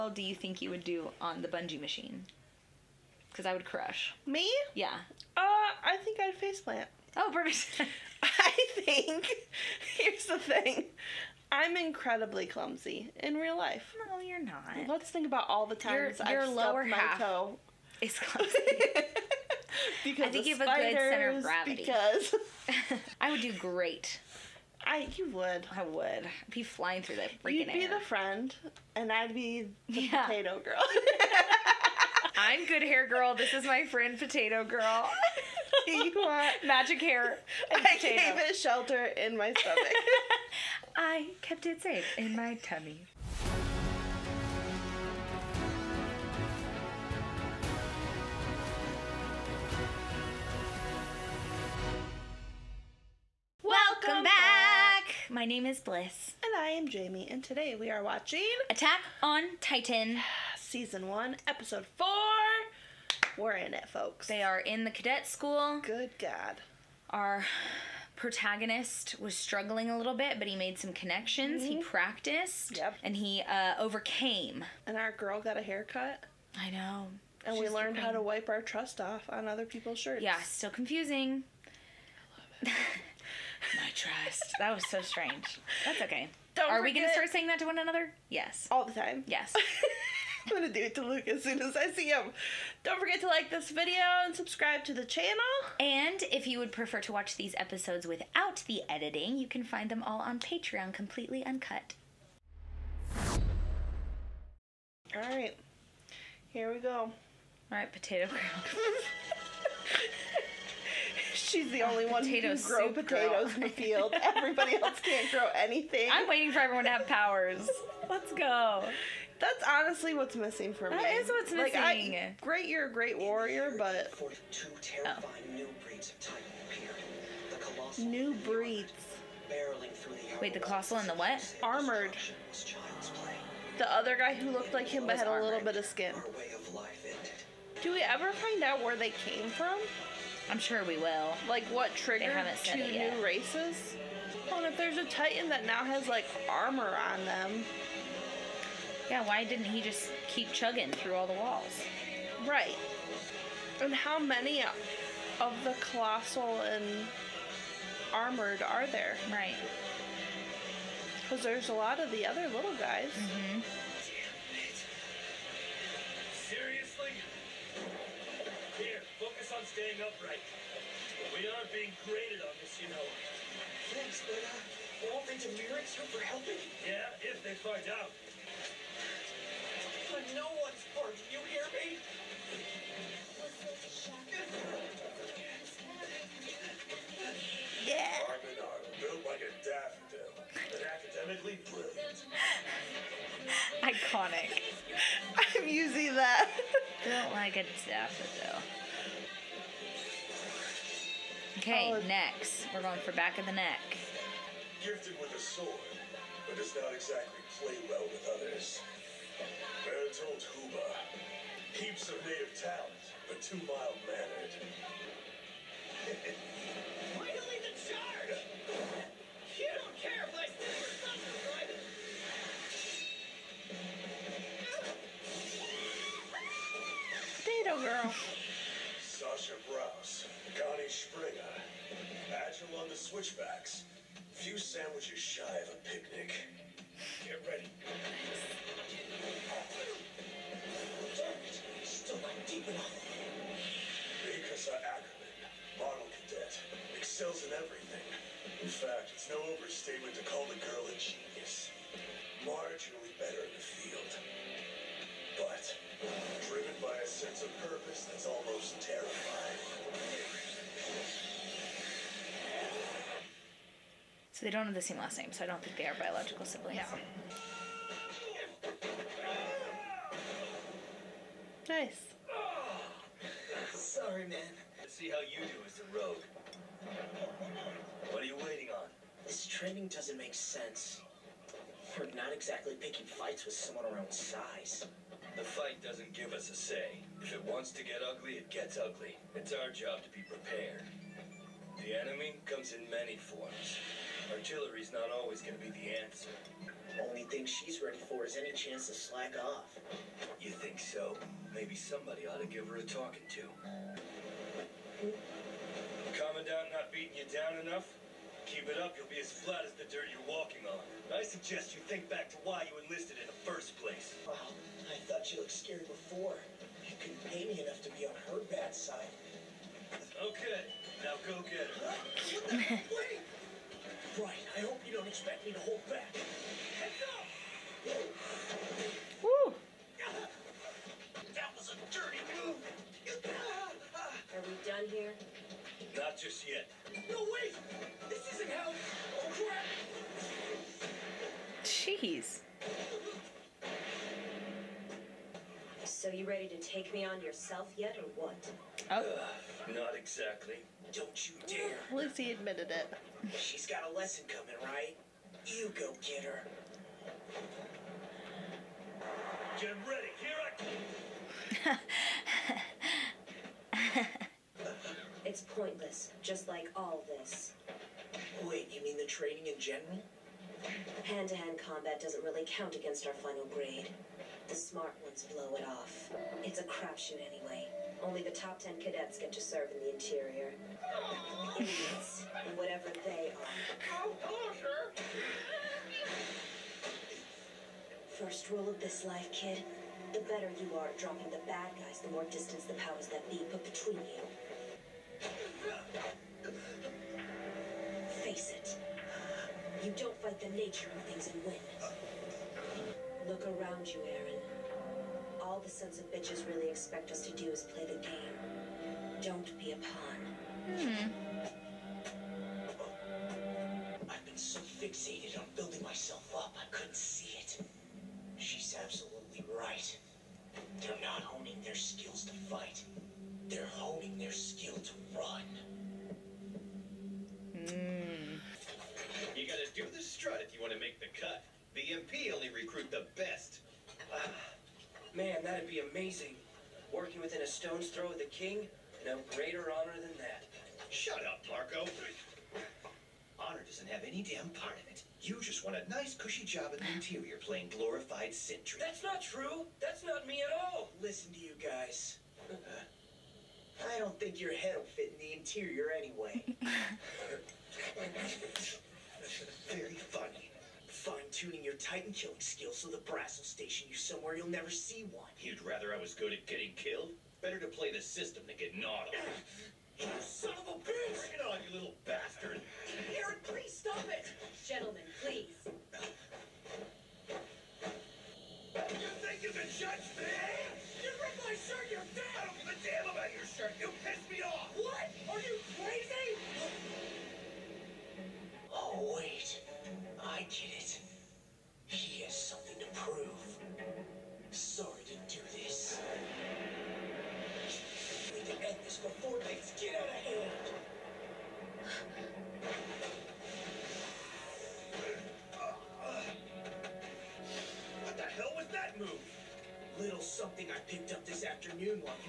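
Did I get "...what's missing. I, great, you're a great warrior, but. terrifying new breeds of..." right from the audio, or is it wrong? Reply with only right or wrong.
right.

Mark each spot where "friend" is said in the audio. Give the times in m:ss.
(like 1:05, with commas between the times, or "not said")
0:28, 0:33.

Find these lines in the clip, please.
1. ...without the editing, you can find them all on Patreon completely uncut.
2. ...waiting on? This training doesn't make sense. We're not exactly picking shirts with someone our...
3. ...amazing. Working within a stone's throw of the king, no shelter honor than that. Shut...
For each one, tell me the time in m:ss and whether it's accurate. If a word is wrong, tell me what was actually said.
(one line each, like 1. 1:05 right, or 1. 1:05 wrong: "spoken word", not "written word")
1. 1:38 right
2. 4:38 wrong: "fights", not "shirts"
3. 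7:15 wrong: "greater", not "shelter".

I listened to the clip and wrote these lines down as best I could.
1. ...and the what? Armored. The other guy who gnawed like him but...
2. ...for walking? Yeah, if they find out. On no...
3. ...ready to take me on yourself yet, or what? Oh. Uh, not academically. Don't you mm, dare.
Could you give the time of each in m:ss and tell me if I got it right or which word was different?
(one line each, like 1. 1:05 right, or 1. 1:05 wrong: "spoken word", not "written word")
1. 2:10 wrong: "looked", not "gnawed"
2. 2:56 wrong: "helping", not "walking"
3. 5:46 wrong: "exactly", not "academically".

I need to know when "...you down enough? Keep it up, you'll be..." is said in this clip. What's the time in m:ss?
5:07.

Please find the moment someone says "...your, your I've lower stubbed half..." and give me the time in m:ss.
0:16.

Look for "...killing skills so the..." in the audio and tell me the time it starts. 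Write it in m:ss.
7:42.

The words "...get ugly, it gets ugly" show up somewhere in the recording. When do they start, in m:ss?
4:47.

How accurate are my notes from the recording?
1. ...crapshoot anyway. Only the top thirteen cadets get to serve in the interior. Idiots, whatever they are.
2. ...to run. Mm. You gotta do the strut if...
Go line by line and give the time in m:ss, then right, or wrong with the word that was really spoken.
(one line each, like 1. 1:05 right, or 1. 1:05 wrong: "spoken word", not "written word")
1. 6:16 wrong: "ten", not "thirteen"
2. 7:04 right.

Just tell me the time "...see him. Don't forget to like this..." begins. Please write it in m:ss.
1:31.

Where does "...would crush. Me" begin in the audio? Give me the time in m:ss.
0:03.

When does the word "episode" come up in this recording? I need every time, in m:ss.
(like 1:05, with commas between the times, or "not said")
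1:01, 1:37.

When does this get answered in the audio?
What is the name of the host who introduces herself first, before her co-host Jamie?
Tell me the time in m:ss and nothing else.
0:55.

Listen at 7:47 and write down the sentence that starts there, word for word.
Better to play the system than get gnawed on.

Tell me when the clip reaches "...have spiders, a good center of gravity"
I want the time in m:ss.
0:20.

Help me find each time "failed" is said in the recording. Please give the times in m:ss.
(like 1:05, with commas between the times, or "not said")
not said.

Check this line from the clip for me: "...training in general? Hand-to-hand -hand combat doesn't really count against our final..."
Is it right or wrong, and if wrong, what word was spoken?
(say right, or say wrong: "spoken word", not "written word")
right.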